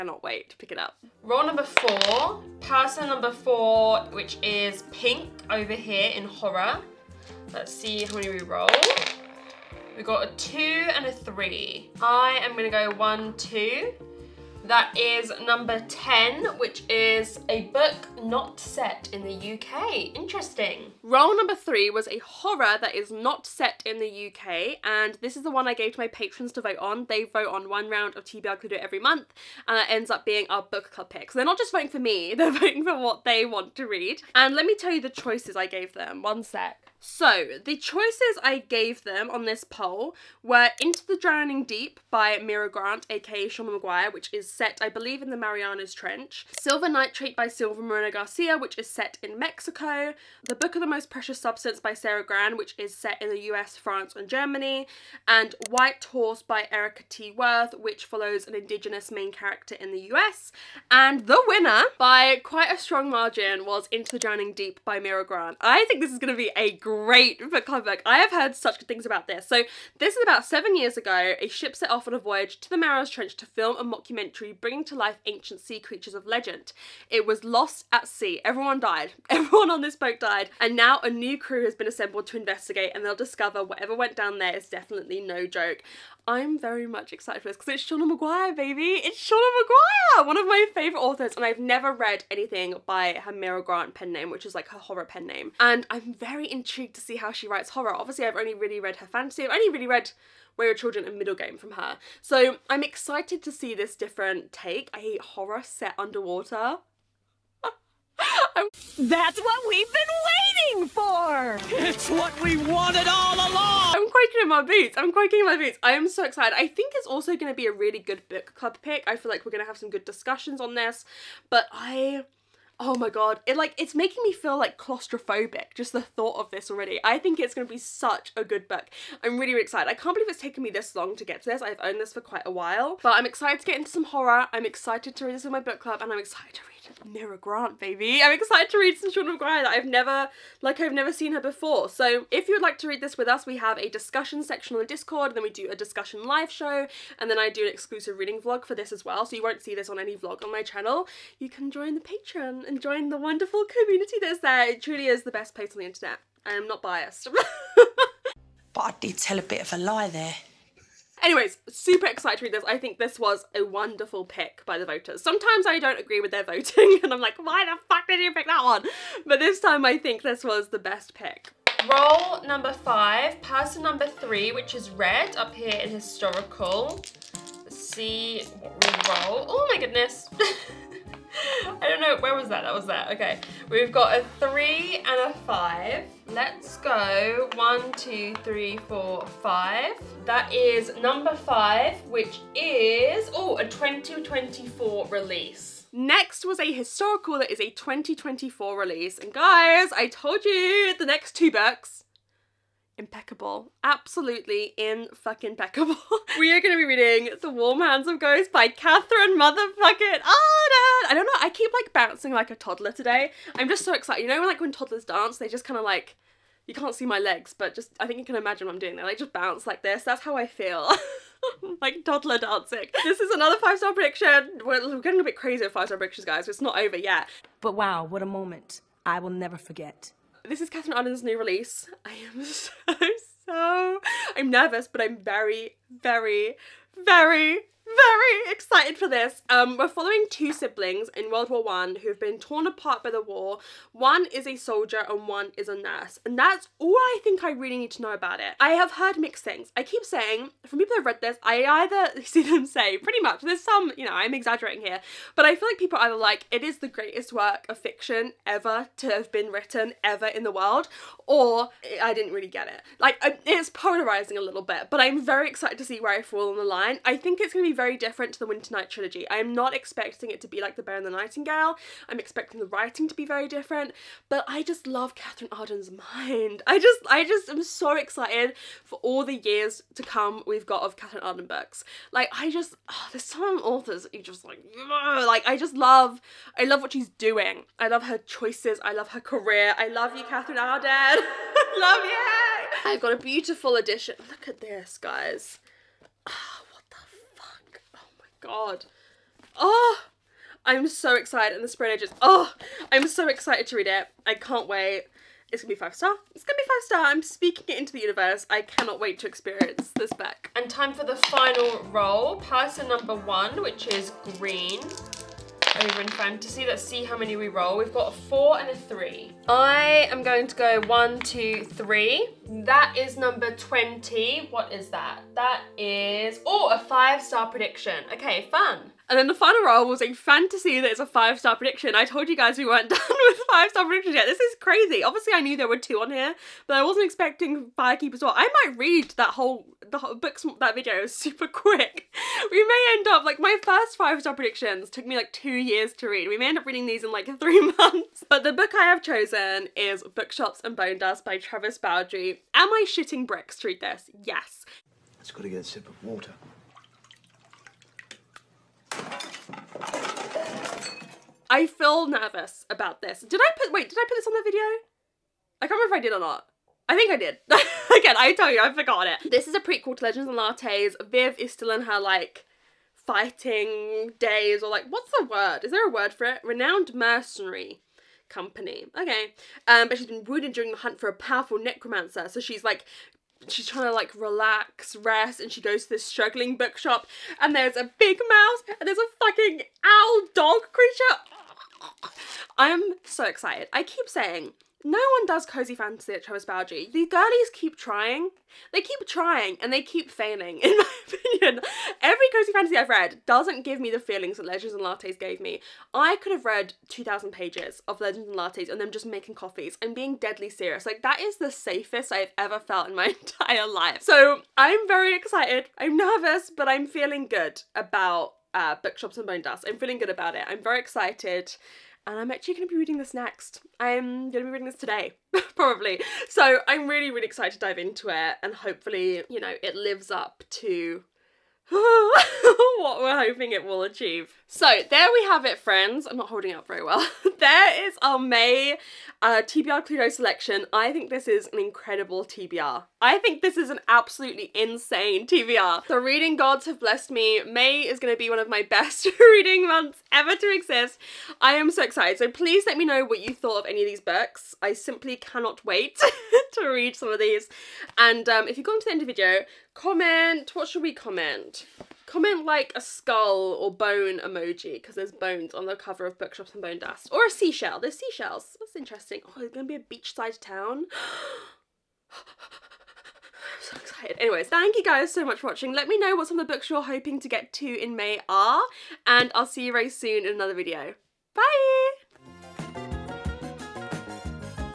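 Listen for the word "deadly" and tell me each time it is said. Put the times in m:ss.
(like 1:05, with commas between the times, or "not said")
6:50.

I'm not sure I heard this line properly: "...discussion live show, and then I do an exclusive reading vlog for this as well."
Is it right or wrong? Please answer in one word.
right.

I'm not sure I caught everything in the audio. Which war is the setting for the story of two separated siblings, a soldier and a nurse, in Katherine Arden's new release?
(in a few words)
World War One.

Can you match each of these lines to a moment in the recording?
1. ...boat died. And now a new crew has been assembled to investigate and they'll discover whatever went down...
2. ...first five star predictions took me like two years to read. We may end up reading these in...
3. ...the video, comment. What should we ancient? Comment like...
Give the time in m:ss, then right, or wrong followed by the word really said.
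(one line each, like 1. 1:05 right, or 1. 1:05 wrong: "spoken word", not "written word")
1. 1:19 right
2. 5:43 right
3. 7:39 wrong: "comment", not "ancient".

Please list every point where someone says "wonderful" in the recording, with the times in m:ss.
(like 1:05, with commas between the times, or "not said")
2:33, 2:43.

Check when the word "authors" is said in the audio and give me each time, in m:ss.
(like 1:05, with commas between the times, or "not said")
1:31, 4:43.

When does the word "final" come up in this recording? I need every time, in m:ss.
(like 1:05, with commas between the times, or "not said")
5:11, 5:29.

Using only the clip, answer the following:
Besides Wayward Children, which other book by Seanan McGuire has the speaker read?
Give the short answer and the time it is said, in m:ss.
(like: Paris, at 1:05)
Middlegame, at 1:41.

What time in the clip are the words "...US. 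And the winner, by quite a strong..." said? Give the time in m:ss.
1:00.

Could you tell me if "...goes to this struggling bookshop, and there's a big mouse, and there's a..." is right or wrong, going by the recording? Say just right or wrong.
right.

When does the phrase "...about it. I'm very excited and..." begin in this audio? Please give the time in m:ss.
7:00.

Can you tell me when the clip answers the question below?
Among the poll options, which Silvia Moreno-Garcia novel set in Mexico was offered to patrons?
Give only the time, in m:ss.
0:46.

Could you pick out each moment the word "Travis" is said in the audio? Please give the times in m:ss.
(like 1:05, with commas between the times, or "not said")
5:51, 6:36.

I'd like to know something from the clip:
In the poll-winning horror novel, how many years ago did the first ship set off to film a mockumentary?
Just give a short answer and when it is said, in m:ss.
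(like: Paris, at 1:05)
7, at 1:10.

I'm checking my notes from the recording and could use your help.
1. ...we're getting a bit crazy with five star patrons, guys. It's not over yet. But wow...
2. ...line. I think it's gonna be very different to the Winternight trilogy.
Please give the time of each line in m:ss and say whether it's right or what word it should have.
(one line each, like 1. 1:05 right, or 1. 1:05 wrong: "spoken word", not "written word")
1. 3:44 wrong: "predictions", not "patrons"
2. 4:26 right.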